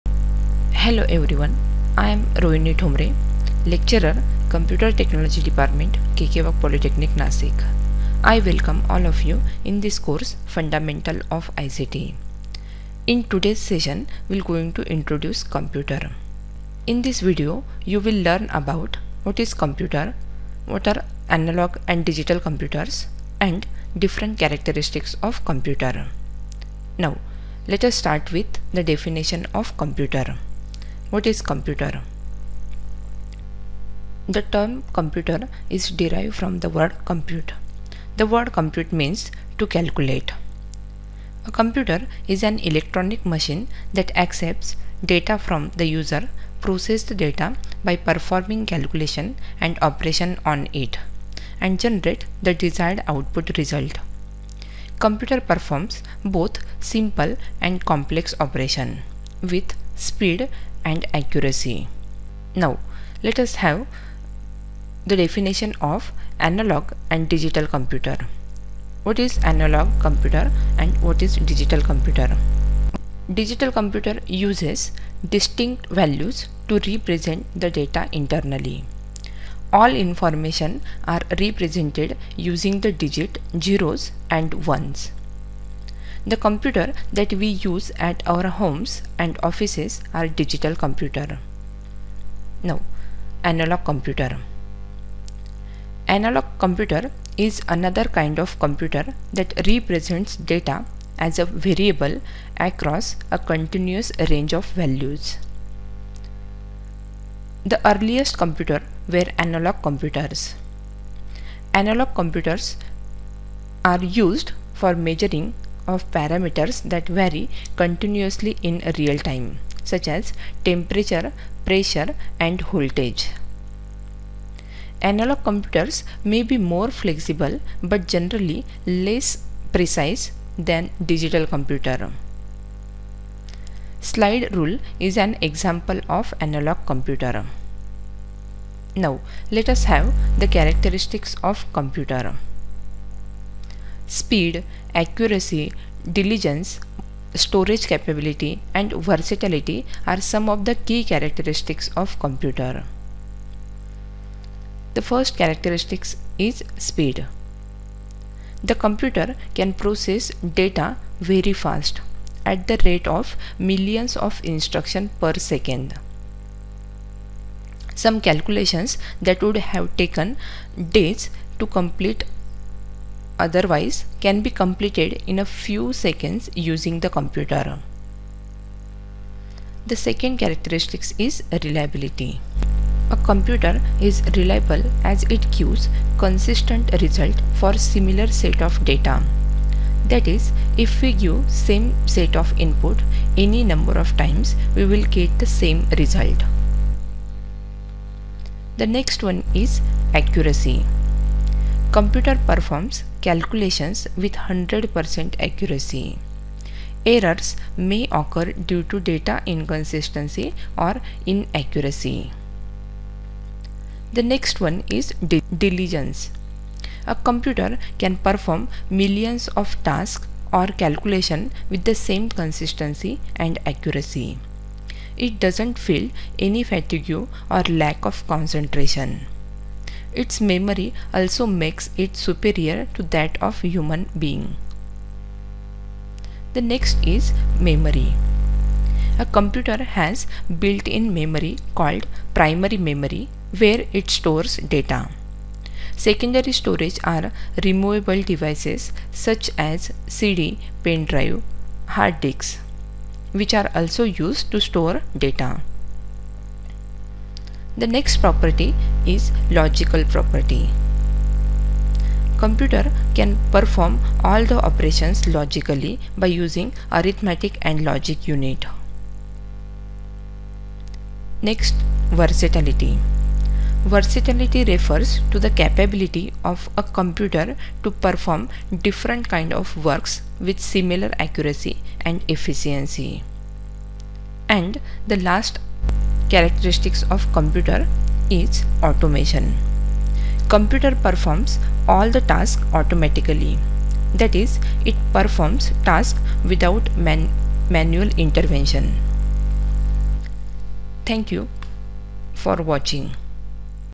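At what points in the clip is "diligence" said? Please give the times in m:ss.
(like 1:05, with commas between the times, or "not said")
2:26, 3:35.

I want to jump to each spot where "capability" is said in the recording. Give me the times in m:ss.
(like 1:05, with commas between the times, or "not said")
2:27, 4:35.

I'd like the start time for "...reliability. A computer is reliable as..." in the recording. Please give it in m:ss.
3:01.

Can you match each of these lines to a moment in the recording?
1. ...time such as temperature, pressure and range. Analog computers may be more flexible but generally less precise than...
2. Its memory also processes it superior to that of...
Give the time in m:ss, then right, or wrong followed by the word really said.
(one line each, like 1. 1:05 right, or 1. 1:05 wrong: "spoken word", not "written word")
1. 1:59 wrong: "voltage", not "range"
2. 3:50 wrong: "makes", not "processes".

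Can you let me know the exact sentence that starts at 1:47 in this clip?
The earliest computer were analog computers.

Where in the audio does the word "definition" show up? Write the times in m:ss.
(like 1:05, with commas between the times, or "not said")
0:28, 1:05.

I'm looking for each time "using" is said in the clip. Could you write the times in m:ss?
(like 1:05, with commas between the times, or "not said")
1:22, 2:56, 4:26.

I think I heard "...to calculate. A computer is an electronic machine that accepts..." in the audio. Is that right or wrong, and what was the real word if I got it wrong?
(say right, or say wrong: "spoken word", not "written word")
right.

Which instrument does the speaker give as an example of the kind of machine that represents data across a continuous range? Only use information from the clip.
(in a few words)
Slide rule.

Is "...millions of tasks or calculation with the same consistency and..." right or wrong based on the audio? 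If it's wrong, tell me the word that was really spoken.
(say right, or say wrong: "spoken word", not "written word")
right.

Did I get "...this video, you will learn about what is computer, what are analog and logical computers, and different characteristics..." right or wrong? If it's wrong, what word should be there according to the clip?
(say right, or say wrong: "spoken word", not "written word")
wrong: "digital", not "logical".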